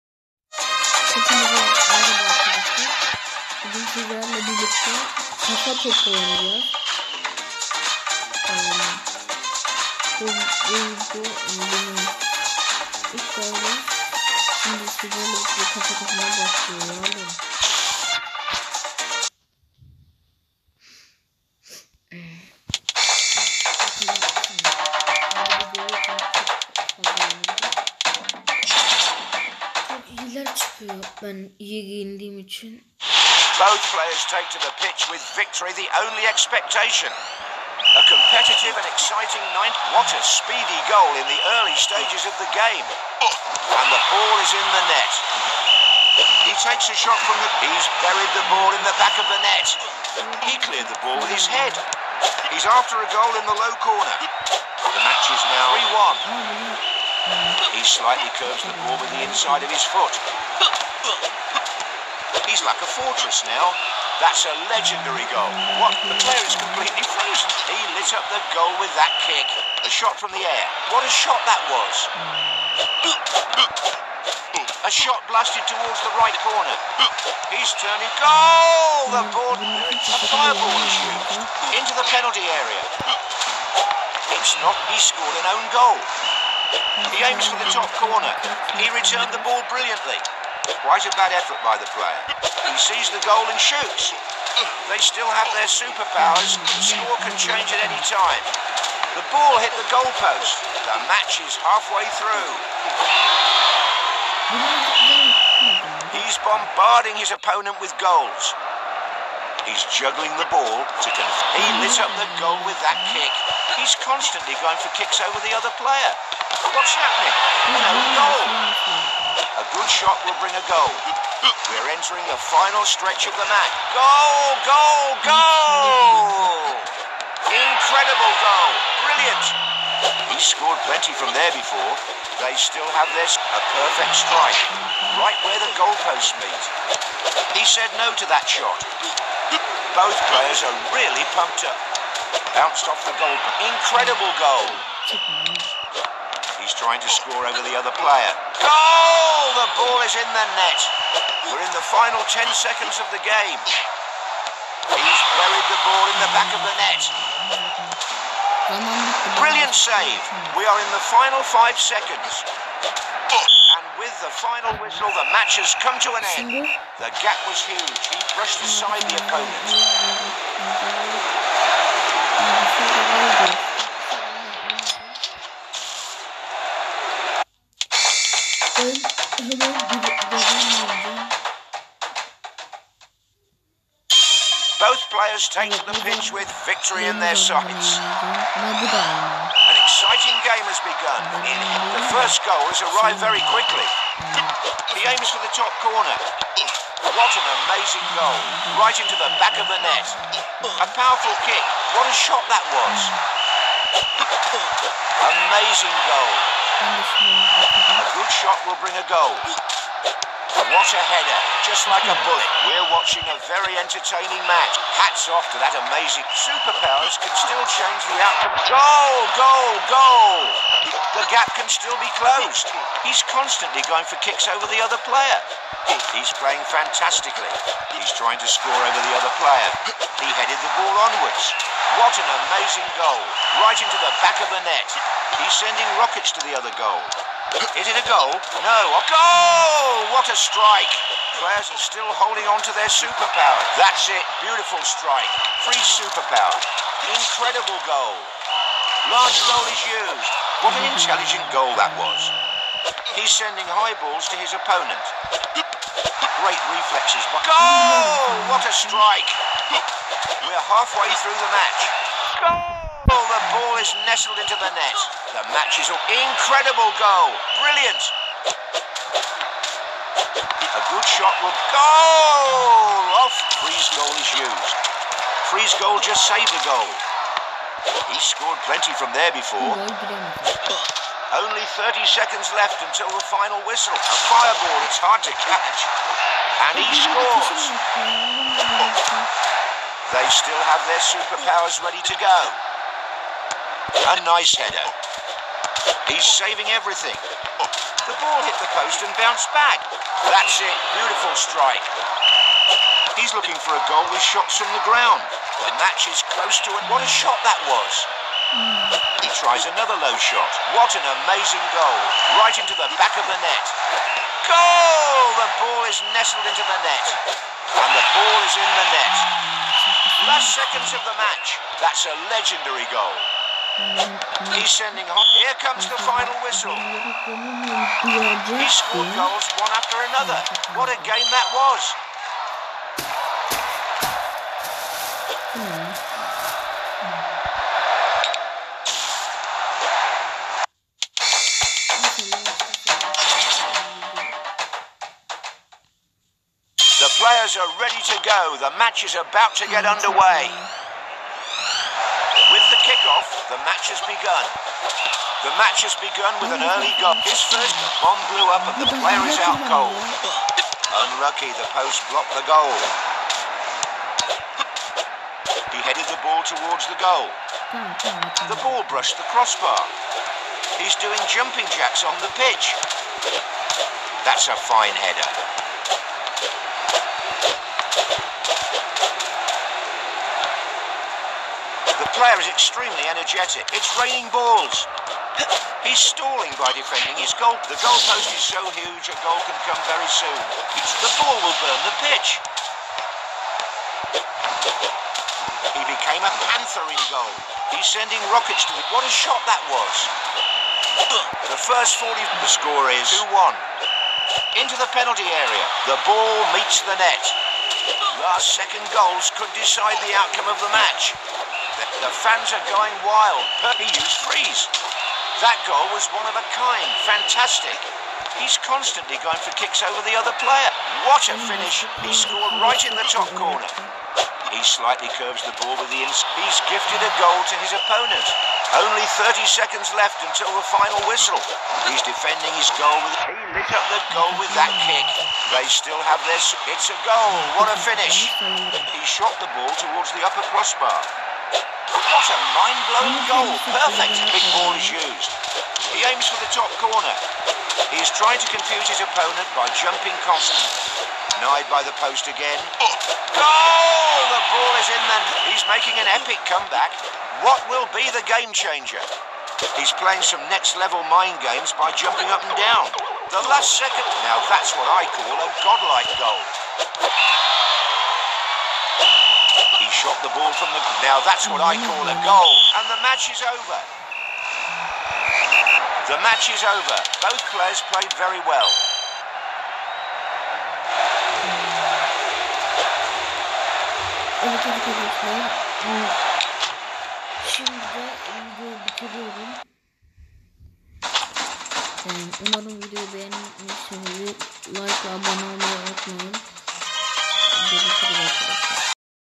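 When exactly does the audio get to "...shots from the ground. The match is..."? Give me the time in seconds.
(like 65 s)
304 s.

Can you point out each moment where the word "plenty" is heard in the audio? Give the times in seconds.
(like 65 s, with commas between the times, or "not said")
130 s, 278 s.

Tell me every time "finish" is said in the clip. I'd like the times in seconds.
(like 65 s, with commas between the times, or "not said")
421 s, 437 s.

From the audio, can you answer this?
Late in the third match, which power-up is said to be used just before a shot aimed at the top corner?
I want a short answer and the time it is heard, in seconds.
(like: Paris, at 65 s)
Perfect big ball, at 443 s.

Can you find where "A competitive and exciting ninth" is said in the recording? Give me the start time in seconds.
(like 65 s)
37 s.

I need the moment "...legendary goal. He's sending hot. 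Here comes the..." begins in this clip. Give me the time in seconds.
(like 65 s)
322 s.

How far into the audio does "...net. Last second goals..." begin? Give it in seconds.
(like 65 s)
406 s.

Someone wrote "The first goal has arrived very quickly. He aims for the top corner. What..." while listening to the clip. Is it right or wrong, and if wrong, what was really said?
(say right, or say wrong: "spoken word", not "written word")
right.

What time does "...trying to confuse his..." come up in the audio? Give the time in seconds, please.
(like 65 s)
448 s.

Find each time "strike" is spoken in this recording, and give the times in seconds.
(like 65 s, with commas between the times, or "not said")
134 s, 240 s, 244 s, 258 s, 301 s.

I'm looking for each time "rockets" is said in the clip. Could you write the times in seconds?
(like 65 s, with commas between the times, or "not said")
235 s, 398 s.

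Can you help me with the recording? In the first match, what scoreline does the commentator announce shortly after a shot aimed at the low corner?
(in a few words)
3-1.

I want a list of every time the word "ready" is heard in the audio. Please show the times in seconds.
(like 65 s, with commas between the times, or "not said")
291 s, 347 s.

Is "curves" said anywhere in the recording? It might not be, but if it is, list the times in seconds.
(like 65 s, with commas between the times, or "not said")
58 s, 425 s.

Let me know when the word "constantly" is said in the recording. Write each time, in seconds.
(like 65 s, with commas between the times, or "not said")
114 s, 223 s, 418 s, 450 s.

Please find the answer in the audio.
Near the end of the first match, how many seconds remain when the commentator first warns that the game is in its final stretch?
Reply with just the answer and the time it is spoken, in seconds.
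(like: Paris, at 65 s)
10, at 152 s.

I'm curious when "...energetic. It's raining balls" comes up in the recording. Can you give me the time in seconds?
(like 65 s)
383 s.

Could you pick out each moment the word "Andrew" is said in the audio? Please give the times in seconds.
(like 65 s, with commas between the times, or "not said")
not said.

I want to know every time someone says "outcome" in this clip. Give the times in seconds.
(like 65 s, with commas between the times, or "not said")
218 s, 410 s.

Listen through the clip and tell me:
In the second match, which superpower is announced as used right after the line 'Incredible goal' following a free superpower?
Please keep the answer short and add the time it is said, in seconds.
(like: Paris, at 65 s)
Large goal, at 249 s.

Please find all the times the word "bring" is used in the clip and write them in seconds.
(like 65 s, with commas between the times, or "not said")
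120 s, 208 s.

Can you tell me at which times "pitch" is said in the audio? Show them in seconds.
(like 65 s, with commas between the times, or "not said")
34 s, 186 s, 372 s, 392 s.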